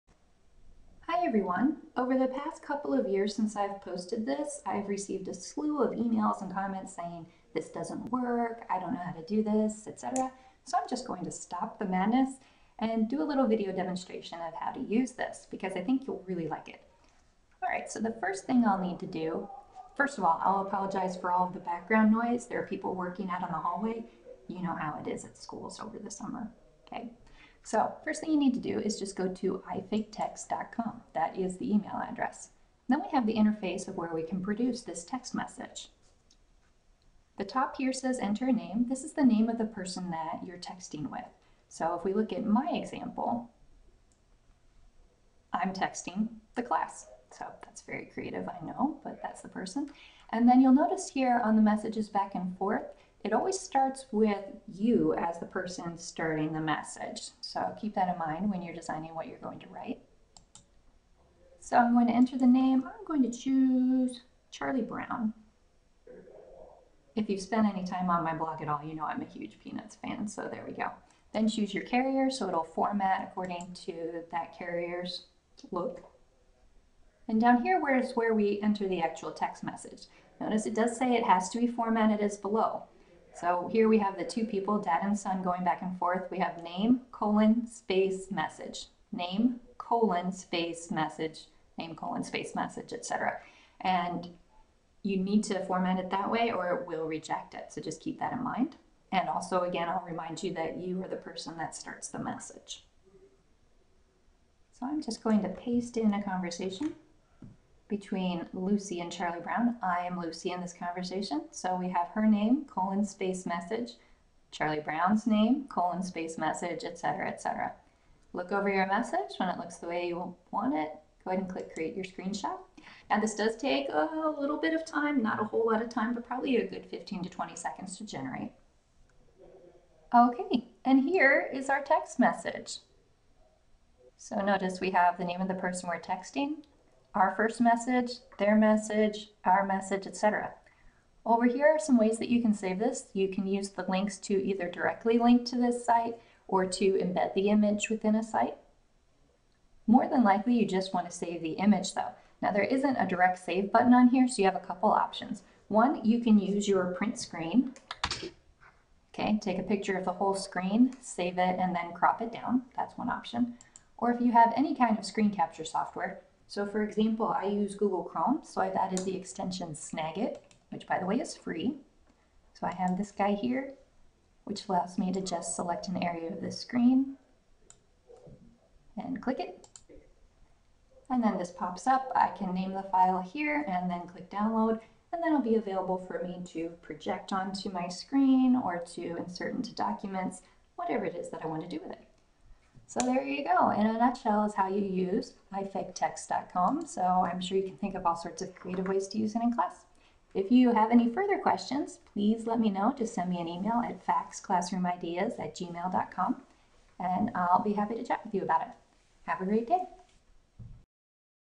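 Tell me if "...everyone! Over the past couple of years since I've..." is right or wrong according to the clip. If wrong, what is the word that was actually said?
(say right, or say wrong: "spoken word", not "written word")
right.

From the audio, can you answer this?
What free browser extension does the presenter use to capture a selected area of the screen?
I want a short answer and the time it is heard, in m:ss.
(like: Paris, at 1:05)
Snagit, at 2:49.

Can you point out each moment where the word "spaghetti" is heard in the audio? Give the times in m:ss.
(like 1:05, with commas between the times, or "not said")
not said.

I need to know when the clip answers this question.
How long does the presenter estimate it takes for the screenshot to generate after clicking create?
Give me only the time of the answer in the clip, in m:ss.
2:06.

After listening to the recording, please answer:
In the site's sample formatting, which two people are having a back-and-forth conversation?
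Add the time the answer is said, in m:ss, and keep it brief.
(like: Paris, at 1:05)
dad and son, at 1:24.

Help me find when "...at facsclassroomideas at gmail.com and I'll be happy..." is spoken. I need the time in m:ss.
3:23.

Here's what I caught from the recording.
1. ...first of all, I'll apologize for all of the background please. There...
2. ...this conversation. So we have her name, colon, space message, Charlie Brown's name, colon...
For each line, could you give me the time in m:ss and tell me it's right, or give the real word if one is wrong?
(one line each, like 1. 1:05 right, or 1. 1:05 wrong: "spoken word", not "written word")
1. 0:19 wrong: "noise", not "please"
2. 1:50 right.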